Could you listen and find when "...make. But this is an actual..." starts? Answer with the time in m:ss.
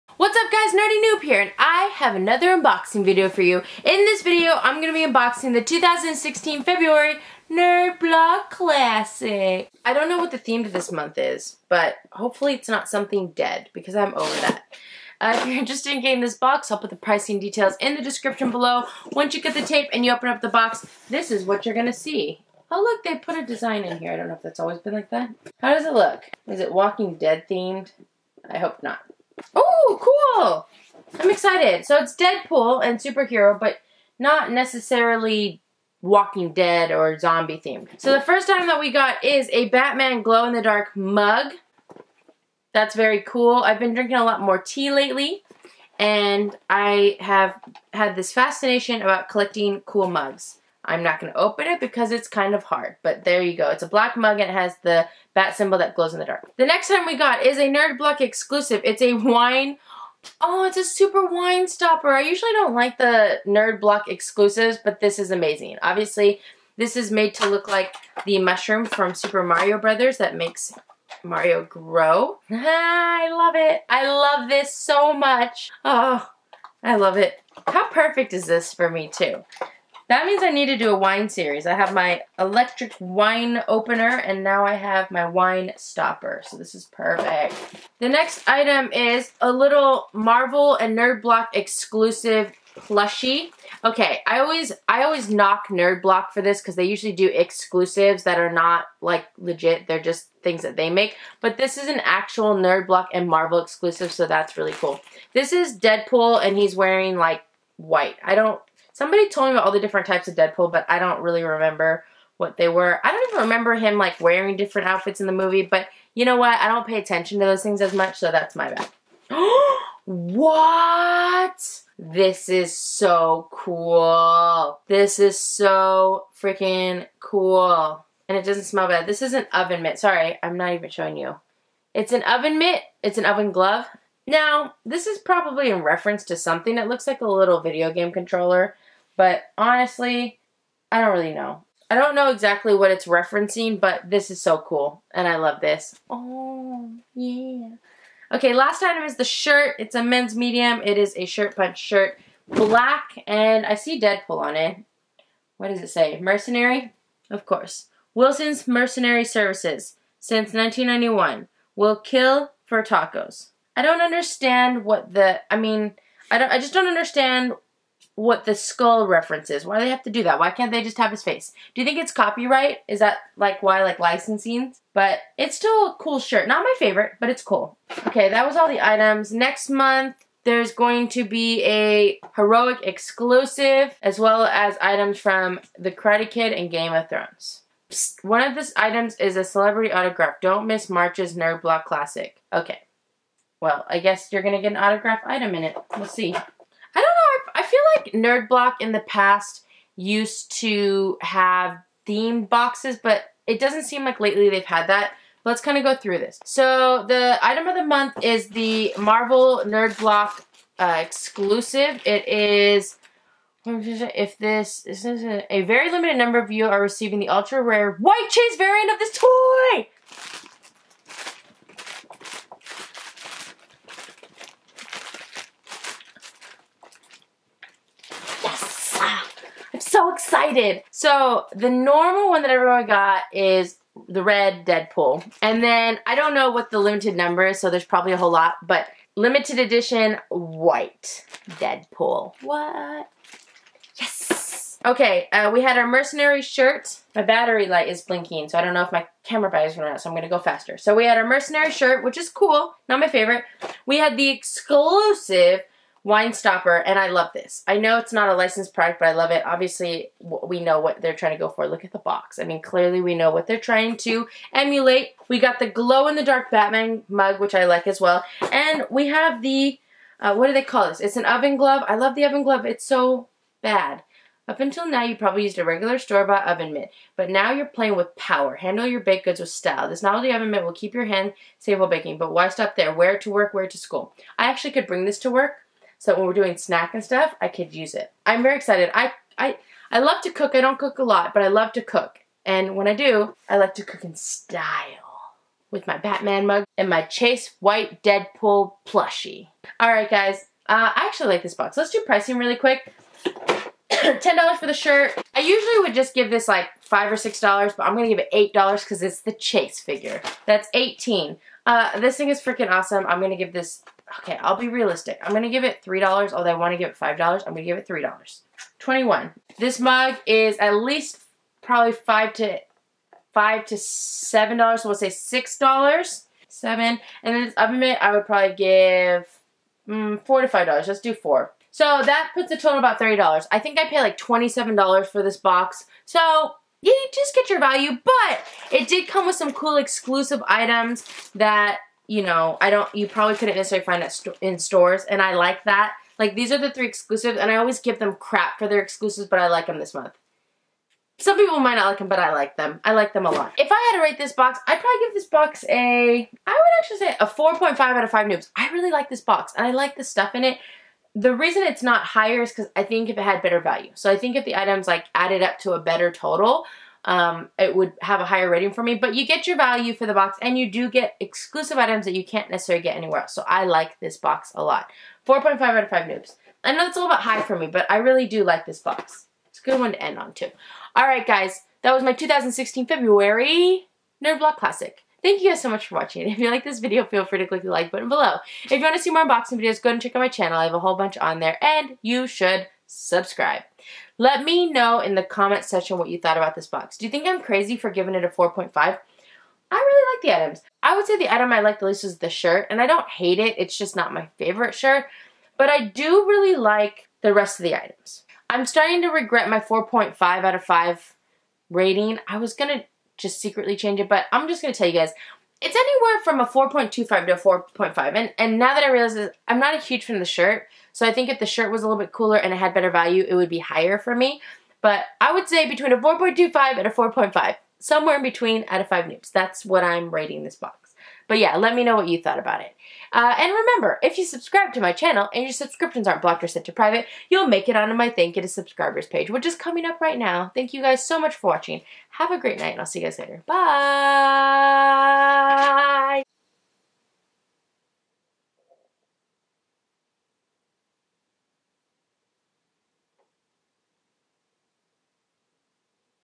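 1:40.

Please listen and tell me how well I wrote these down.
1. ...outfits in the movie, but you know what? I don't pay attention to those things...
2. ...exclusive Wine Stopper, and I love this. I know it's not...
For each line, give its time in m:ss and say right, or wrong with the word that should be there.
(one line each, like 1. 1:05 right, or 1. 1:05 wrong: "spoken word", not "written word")
1. 1:54 right
2. 4:14 right.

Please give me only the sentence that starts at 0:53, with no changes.
It's a black mug and it has the bat symbol that glows in the dark.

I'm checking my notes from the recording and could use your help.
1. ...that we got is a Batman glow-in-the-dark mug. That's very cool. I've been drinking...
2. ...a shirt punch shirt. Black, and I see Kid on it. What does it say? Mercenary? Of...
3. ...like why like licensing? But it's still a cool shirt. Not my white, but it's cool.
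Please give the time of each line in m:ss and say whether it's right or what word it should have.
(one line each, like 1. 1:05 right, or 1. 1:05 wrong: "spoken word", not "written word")
1. 0:38 right
2. 2:31 wrong: "Deadpool", not "Kid"
3. 2:53 wrong: "favorite", not "white".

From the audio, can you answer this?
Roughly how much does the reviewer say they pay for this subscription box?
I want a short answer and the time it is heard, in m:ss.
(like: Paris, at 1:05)
$27, at 5:34.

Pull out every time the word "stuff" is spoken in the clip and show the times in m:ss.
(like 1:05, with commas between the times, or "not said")
4:47, 6:00.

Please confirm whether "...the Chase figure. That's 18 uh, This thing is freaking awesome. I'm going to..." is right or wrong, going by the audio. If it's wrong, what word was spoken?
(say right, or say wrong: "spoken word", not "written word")
right.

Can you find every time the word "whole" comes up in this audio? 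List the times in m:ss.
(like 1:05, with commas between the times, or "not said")
3:58, 6:30.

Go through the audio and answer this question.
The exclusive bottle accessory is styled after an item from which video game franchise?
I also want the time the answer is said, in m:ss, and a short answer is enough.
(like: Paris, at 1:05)
Super Mario Brothers, at 1:09.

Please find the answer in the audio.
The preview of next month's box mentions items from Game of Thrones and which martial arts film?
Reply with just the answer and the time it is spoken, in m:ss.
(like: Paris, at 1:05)
The Karate Kid, at 3:05.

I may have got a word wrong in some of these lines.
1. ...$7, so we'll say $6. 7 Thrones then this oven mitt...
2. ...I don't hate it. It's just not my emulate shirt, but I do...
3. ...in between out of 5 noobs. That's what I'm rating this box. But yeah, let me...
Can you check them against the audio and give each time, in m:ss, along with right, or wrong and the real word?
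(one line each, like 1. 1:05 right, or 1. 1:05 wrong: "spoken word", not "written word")
1. 5:23 wrong: "And", not "Thrones"
2. 6:42 wrong: "favorite", not "emulate"
3. 7:08 right.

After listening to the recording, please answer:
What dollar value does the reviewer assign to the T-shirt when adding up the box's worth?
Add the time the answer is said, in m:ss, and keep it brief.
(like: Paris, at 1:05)
$10, at 5:03.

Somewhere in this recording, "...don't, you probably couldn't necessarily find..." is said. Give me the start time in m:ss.
5:42.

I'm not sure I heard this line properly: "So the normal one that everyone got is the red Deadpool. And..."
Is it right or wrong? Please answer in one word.
right.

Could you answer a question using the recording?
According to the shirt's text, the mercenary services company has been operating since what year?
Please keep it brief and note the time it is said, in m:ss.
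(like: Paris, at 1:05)
1991, at 2:40.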